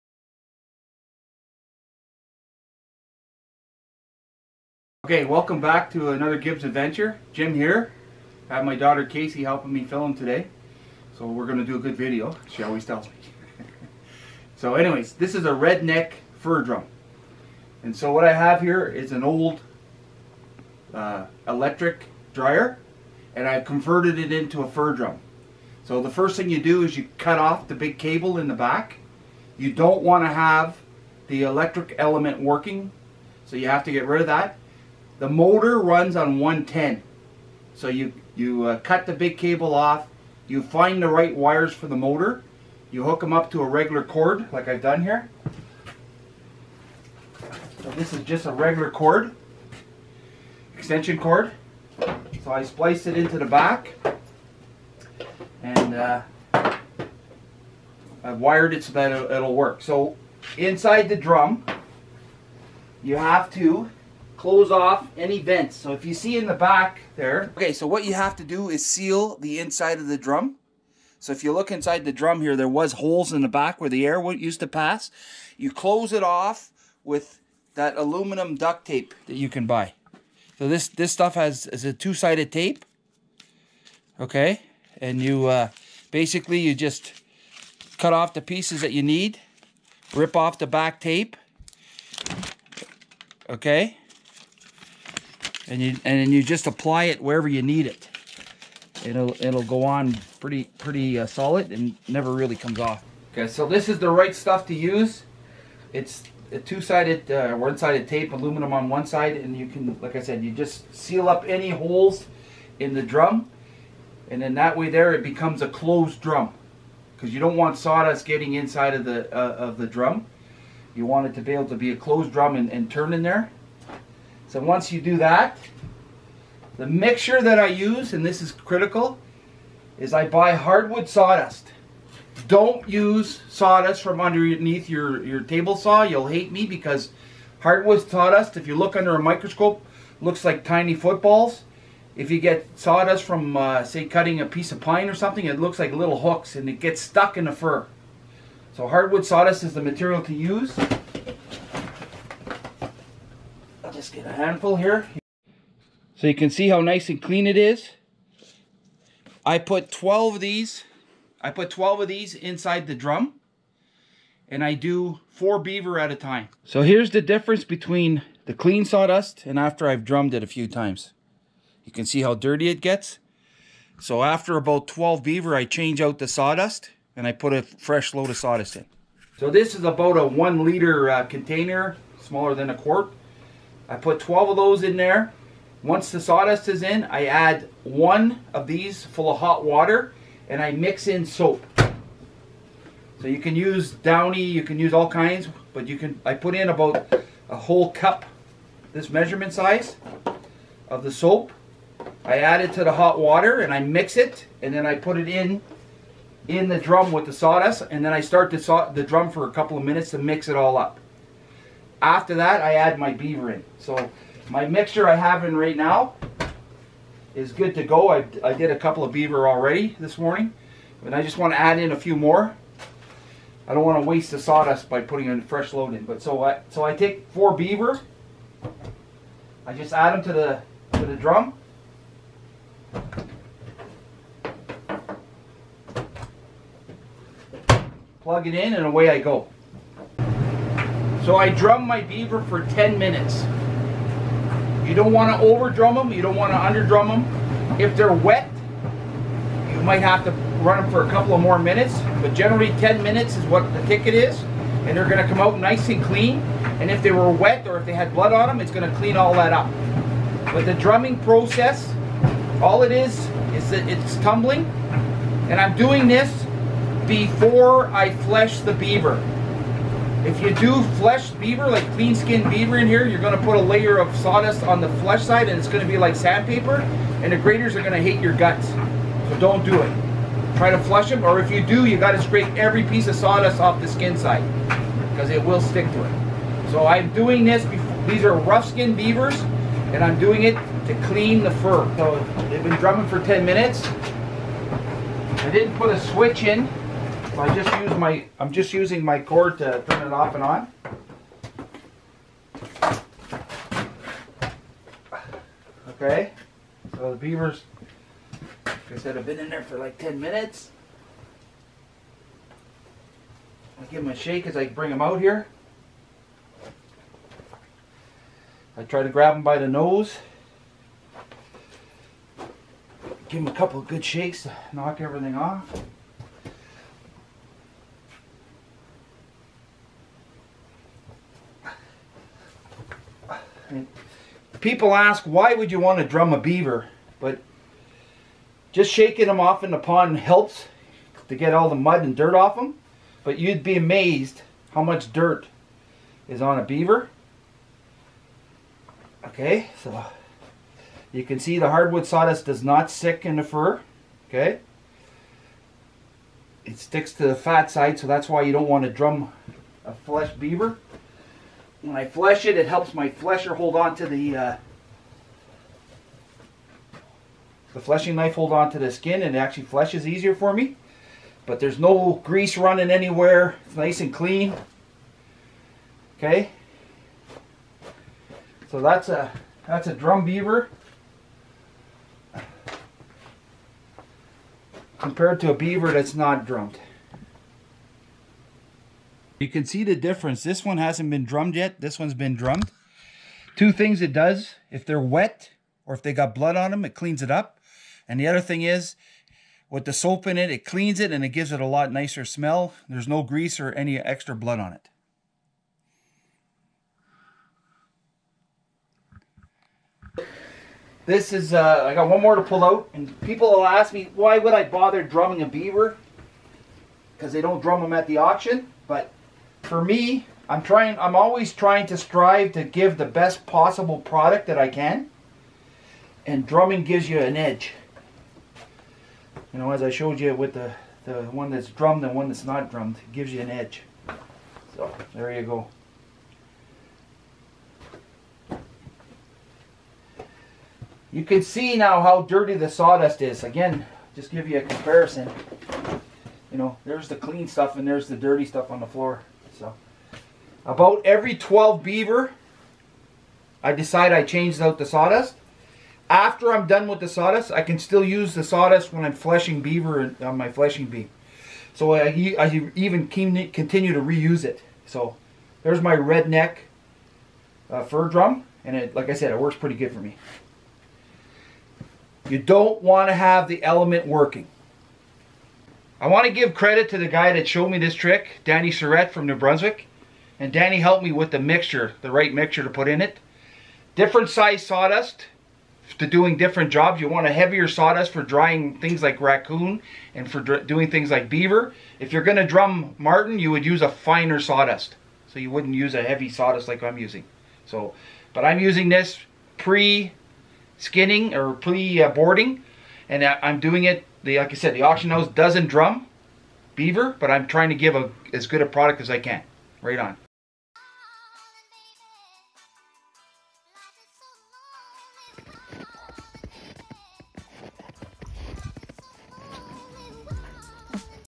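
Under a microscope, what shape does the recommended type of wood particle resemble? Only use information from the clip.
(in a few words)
tiny footballs.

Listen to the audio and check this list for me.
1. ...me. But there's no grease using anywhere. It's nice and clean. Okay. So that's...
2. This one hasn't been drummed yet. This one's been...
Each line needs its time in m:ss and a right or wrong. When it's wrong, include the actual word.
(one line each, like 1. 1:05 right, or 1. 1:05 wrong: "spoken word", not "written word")
1. 6:10 wrong: "running", not "using"
2. 6:30 right.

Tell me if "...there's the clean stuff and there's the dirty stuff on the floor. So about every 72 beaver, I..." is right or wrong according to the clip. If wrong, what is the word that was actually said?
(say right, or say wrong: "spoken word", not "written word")
wrong: "12", not "72".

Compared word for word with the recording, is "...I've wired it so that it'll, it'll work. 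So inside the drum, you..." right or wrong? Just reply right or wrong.
right.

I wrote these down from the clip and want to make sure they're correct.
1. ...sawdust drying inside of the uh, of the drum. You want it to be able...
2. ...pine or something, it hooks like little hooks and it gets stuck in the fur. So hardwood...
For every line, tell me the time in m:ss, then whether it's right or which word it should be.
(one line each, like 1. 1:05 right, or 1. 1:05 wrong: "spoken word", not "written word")
1. 1:57 wrong: "getting", not "drying"
2. 2:24 wrong: "looks", not "hooks".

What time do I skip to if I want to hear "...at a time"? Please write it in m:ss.
2:45.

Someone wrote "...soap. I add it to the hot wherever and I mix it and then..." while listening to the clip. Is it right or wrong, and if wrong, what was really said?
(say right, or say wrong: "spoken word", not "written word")
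wrong: "water", not "wherever".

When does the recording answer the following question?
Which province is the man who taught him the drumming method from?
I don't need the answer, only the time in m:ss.
7:59.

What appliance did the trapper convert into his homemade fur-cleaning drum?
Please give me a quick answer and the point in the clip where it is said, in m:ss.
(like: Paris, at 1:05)
electric dryer, at 0:21.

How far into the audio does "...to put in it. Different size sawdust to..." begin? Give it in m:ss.
8:02.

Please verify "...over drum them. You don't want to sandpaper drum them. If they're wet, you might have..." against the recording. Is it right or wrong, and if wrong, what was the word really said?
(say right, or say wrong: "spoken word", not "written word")
wrong: "under", not "sandpaper".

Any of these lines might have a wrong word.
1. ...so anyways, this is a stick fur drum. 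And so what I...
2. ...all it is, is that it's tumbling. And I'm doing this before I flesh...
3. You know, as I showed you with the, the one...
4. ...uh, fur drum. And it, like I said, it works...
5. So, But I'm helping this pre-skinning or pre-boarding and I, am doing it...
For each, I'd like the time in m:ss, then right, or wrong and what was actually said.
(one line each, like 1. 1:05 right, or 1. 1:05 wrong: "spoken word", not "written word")
1. 0:14 wrong: "redneck", not "stick"
2. 4:22 right
3. 7:09 right
4. 7:47 right
5. 8:17 wrong: "using", not "helping".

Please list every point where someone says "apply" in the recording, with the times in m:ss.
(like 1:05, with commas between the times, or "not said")
1:36.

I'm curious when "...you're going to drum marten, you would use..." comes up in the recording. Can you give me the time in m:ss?
8:12.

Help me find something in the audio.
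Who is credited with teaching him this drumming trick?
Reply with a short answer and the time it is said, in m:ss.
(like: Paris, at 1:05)
Danny Surrett, at 7:58.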